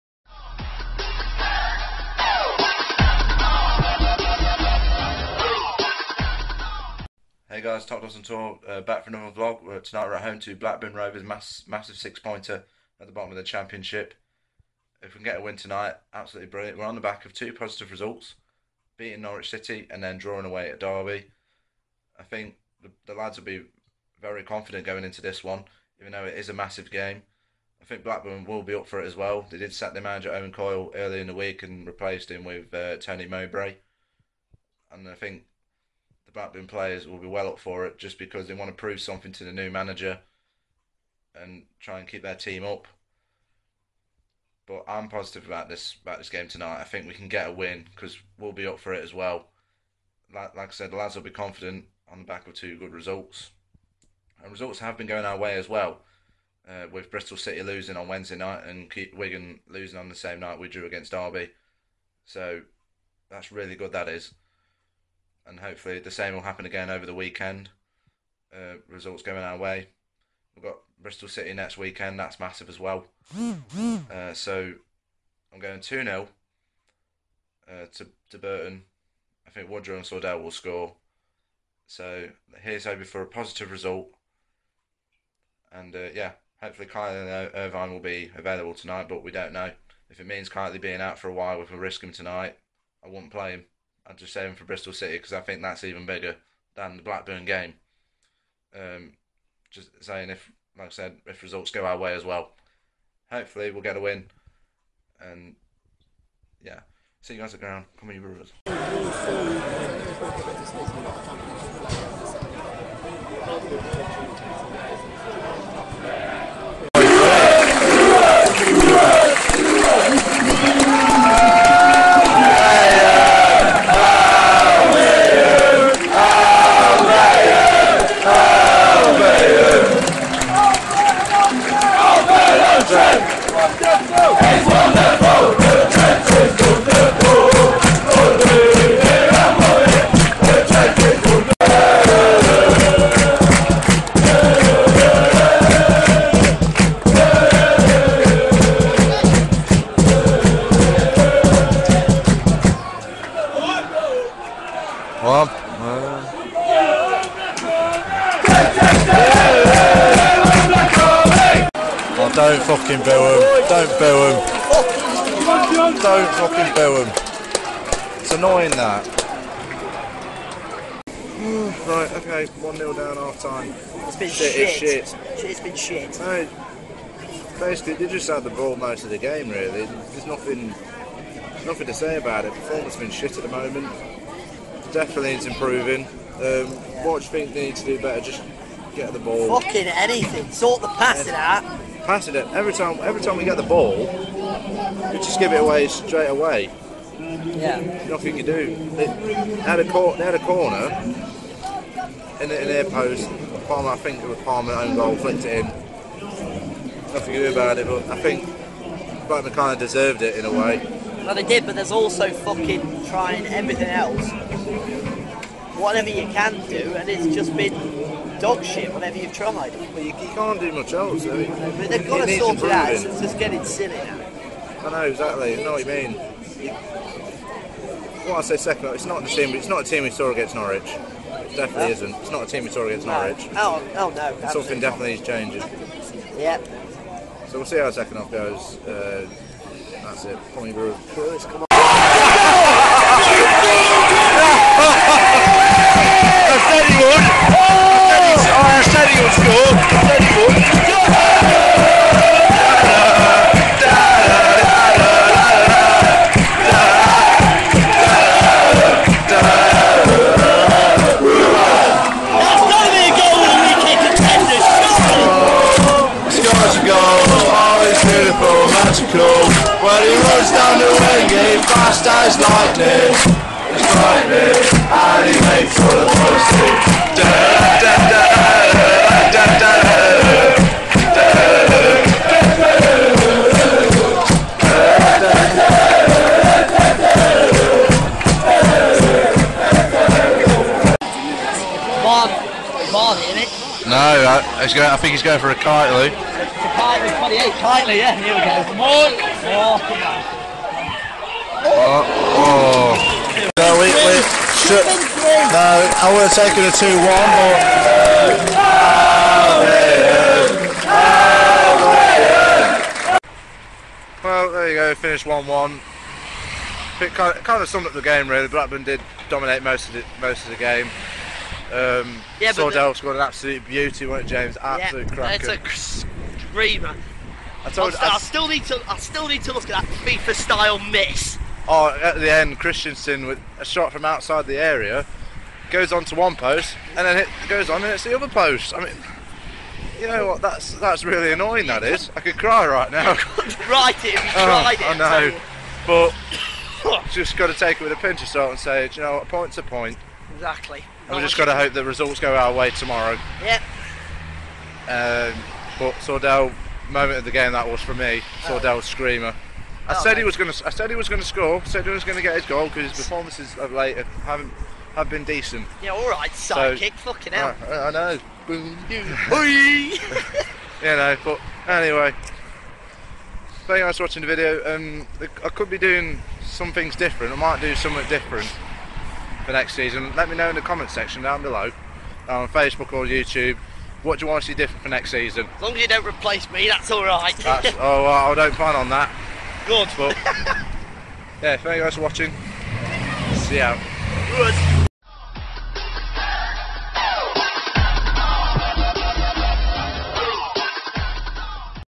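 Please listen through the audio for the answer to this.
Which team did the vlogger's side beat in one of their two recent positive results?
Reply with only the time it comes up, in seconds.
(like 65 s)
19 s.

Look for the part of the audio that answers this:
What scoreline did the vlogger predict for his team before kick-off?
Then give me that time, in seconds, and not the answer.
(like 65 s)
75 s.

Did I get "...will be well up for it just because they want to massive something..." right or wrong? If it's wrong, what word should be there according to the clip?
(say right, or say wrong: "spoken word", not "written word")
wrong: "prove", not "massive".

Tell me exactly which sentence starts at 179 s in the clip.
There's nothing nothing to say about it.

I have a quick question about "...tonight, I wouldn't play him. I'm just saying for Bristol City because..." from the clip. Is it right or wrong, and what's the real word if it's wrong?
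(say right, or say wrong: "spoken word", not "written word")
right.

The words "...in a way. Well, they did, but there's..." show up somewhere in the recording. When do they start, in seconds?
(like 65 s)
210 s.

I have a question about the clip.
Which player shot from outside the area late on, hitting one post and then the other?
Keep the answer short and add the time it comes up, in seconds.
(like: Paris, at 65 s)
Christensen, at 332 s.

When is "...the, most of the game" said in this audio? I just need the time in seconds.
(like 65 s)
319 s.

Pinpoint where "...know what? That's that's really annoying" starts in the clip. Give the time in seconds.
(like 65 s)
340 s.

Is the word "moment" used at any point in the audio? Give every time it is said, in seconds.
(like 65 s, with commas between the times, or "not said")
183 s, 356 s.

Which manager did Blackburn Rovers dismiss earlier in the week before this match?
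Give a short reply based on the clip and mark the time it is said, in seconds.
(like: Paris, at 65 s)
Owen Coyle, at 30 s.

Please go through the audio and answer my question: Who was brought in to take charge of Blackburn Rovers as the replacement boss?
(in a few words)
Tony Mowbray.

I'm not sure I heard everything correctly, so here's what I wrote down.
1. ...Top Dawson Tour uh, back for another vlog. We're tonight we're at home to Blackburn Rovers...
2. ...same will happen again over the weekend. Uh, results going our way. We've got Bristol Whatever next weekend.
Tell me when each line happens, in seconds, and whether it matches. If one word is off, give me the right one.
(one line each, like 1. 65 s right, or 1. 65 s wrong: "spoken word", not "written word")
1. 7 s right
2. 66 s wrong: "City", not "Whatever".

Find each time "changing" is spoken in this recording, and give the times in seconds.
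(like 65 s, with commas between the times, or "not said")
235 s.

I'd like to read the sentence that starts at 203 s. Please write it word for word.
Palmer, I think it was Palmer own goal, flicked it in.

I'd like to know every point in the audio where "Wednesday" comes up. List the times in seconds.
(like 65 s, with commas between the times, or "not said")
58 s.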